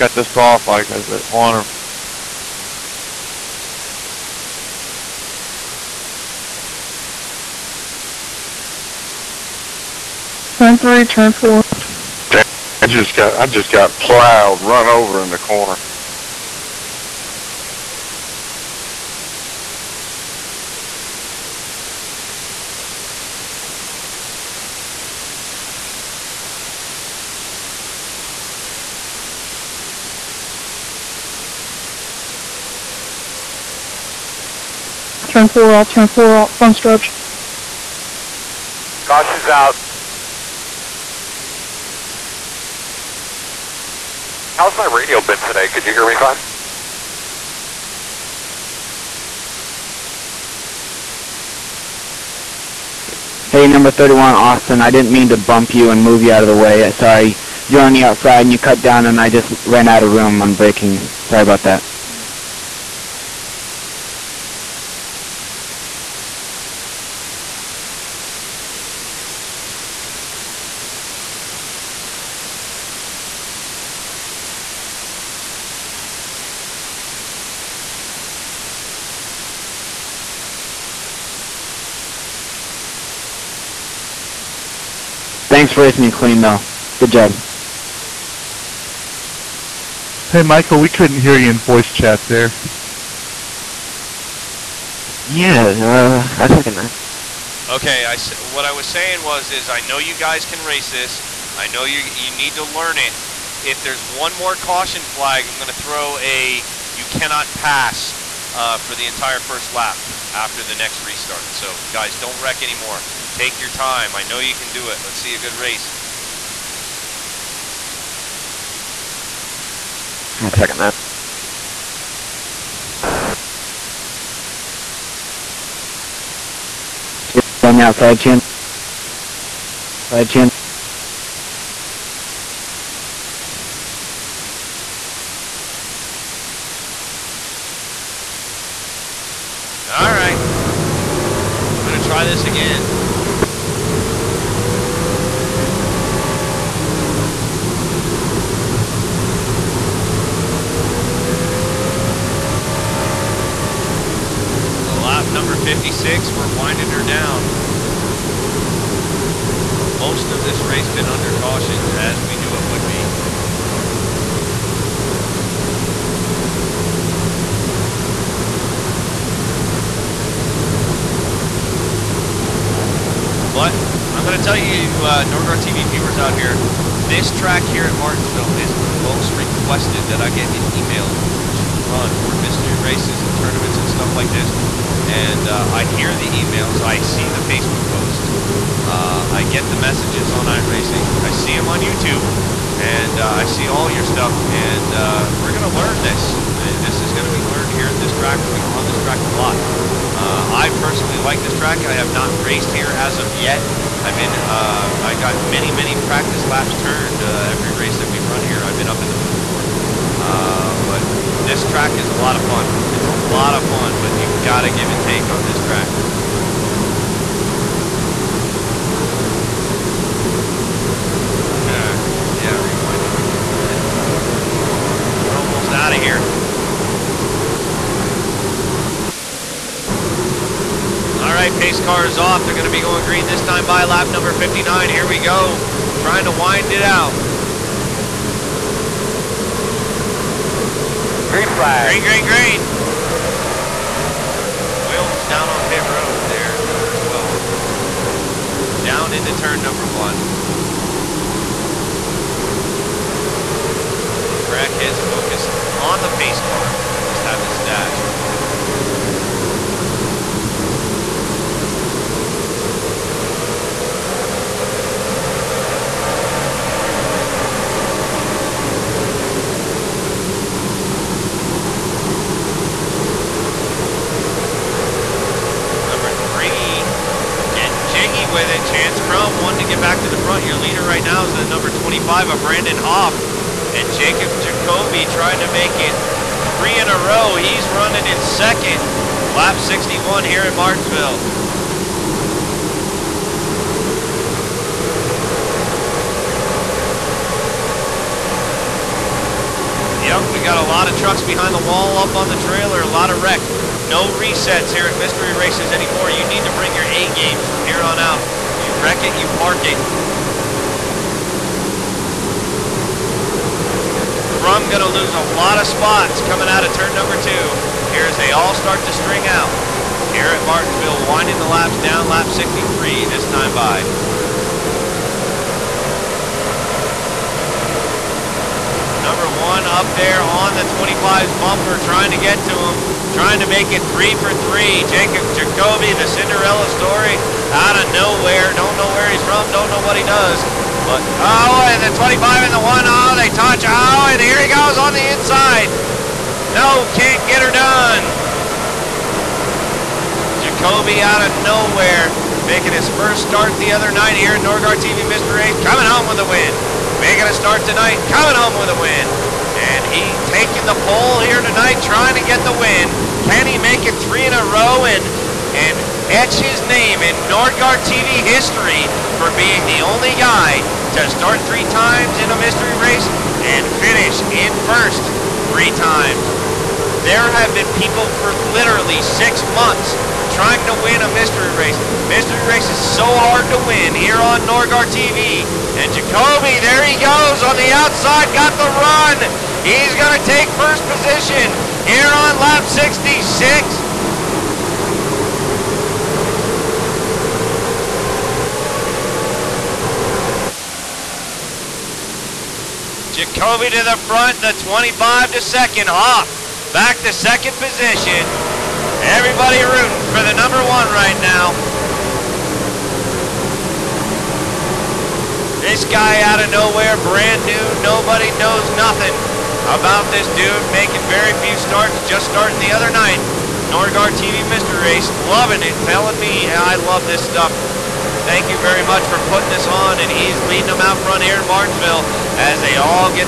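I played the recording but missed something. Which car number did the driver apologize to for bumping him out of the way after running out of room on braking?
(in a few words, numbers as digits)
31.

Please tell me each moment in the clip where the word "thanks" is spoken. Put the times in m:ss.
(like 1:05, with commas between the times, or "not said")
1:25, 7:08.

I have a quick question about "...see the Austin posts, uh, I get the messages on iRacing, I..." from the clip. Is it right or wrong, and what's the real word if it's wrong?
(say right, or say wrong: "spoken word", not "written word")
wrong: "Facebook", not "Austin".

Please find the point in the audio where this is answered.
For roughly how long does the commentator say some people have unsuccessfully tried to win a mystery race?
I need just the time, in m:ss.
6:19.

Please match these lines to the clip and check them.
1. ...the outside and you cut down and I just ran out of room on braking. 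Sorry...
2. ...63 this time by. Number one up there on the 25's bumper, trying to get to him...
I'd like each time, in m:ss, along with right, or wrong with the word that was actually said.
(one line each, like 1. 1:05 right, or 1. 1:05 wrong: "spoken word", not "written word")
1. 0:57 right
2. 5:22 right.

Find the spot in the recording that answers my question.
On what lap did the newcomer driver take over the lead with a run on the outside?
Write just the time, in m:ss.
6:32.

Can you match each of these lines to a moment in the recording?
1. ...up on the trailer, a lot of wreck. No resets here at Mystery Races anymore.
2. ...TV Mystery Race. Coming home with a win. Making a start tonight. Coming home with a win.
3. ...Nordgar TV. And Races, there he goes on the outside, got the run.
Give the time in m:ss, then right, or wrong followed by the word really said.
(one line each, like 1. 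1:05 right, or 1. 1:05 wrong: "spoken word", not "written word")
1. 5:02 right
2. 5:54 right
3. 6:24 wrong: "Jacoby", not "Races".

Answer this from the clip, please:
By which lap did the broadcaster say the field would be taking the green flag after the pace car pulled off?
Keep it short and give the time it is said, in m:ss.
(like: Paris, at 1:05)
59, at 3:53.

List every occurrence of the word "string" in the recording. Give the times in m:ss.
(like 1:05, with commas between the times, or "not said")
5:18.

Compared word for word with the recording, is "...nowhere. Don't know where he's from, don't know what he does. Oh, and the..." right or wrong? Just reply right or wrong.
right.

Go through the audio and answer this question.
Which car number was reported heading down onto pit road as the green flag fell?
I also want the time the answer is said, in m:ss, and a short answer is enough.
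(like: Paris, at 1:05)
12, at 4:06.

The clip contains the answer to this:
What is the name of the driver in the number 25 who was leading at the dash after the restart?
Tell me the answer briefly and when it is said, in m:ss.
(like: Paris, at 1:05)
Brandon Hoff, at 4:42.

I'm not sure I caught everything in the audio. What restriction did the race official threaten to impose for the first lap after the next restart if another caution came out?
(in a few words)
you cannot pass.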